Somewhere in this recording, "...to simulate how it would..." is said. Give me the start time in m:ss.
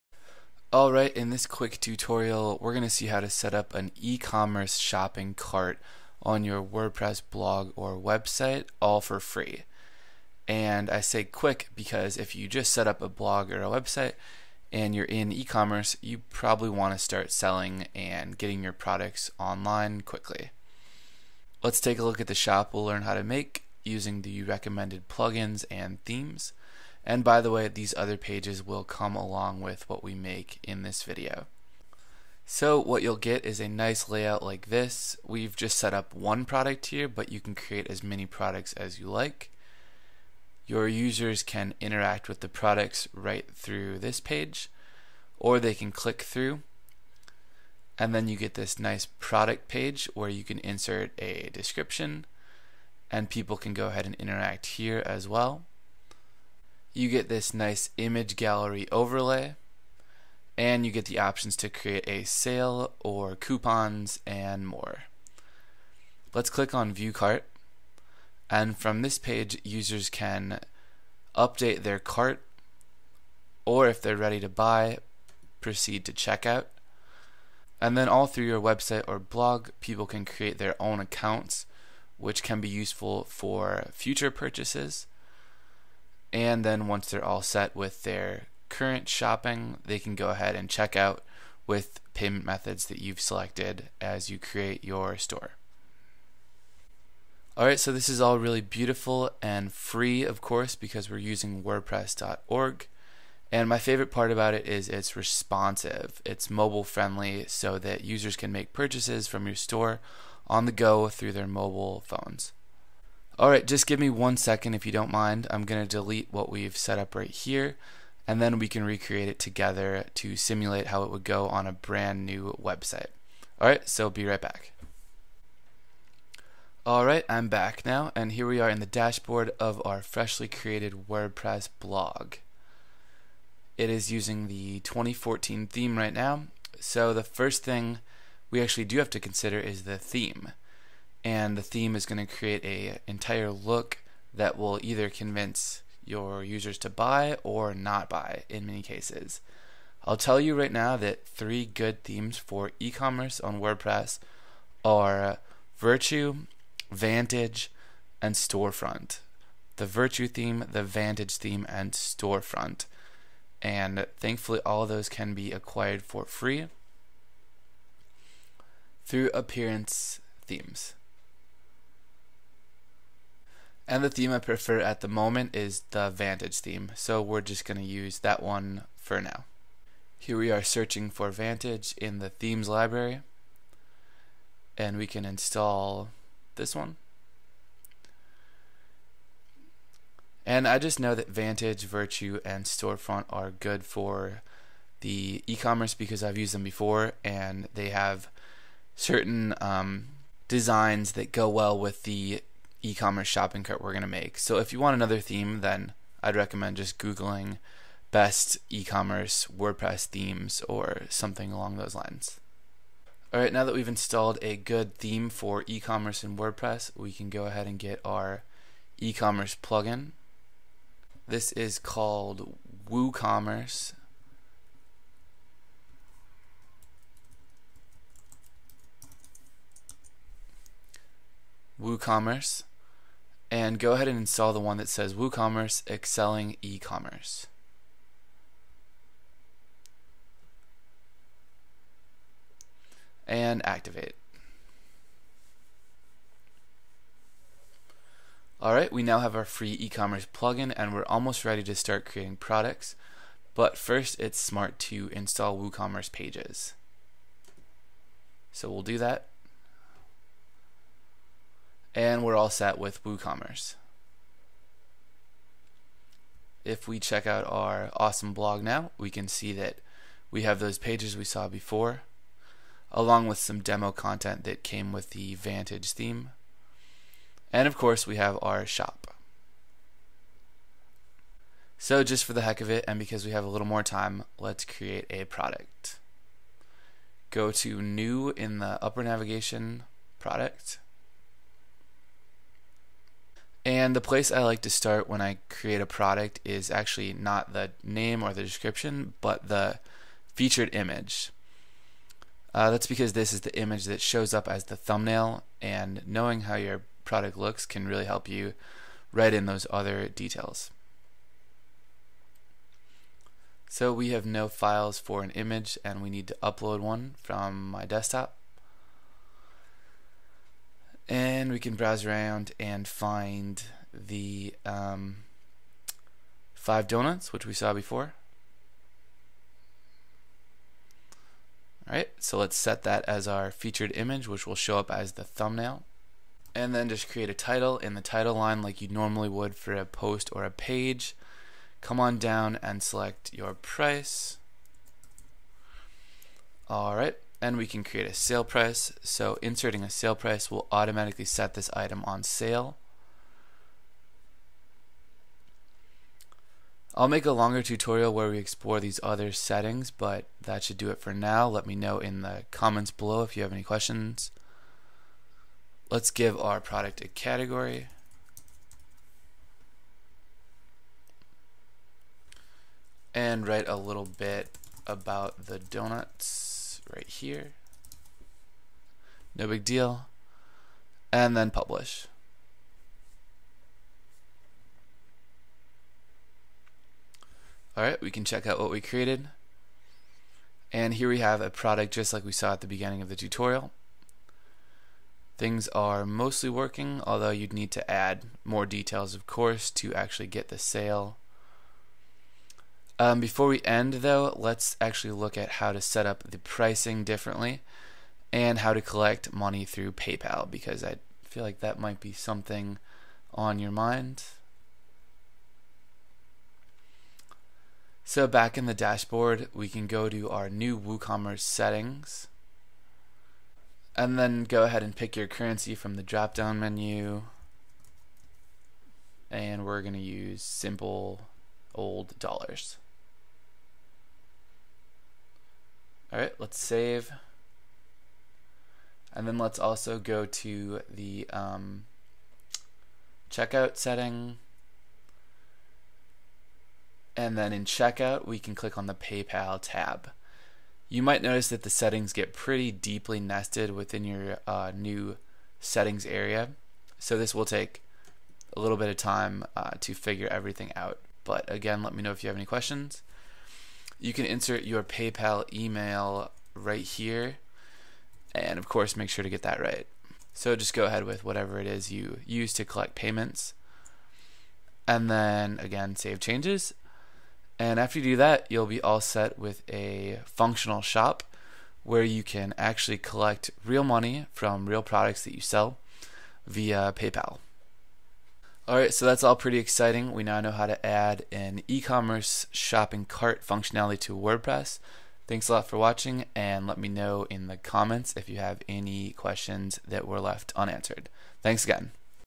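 2:00.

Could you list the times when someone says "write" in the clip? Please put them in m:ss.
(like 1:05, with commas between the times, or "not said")
5:09, 6:13.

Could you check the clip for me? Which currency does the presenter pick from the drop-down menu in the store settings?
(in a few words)
Dollars.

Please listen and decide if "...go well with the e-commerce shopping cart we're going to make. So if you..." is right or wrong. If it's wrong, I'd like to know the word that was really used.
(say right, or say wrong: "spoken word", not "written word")
right.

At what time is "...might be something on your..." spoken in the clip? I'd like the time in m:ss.
6:51.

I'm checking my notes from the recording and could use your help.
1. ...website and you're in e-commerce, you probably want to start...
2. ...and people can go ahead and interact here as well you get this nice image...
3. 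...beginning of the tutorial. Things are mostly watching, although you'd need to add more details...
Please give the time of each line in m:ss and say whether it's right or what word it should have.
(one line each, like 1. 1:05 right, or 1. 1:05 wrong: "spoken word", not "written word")
1. 0:13 right
2. 0:53 right
3. 6:32 wrong: "working", not "watching".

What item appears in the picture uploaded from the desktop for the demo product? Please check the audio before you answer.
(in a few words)
Five donuts.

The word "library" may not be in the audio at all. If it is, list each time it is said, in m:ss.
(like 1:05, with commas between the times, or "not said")
3:02.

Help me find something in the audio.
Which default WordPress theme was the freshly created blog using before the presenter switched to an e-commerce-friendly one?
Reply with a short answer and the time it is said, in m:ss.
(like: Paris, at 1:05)
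2014, at 2:14.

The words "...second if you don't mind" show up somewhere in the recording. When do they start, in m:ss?
1:54.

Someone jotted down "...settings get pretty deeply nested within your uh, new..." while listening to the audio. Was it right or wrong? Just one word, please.
right.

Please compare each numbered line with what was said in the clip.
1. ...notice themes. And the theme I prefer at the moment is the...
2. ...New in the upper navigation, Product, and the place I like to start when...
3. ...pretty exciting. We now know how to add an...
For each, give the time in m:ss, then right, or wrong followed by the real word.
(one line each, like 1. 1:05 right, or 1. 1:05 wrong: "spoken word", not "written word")
1. 2:49 wrong: "appearance", not "notice"
2. 4:47 right
3. 8:09 right.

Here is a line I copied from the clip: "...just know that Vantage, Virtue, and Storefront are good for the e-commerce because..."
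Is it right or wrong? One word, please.
right.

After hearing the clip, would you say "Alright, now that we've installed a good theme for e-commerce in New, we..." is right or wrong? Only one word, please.
wrong.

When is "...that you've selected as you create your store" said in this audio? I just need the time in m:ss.
1:32.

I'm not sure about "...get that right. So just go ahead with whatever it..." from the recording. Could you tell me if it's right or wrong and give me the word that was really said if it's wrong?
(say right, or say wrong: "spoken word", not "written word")
right.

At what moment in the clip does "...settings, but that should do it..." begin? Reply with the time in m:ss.
5:59.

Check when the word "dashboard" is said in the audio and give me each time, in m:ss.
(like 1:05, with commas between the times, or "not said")
2:08, 6:58.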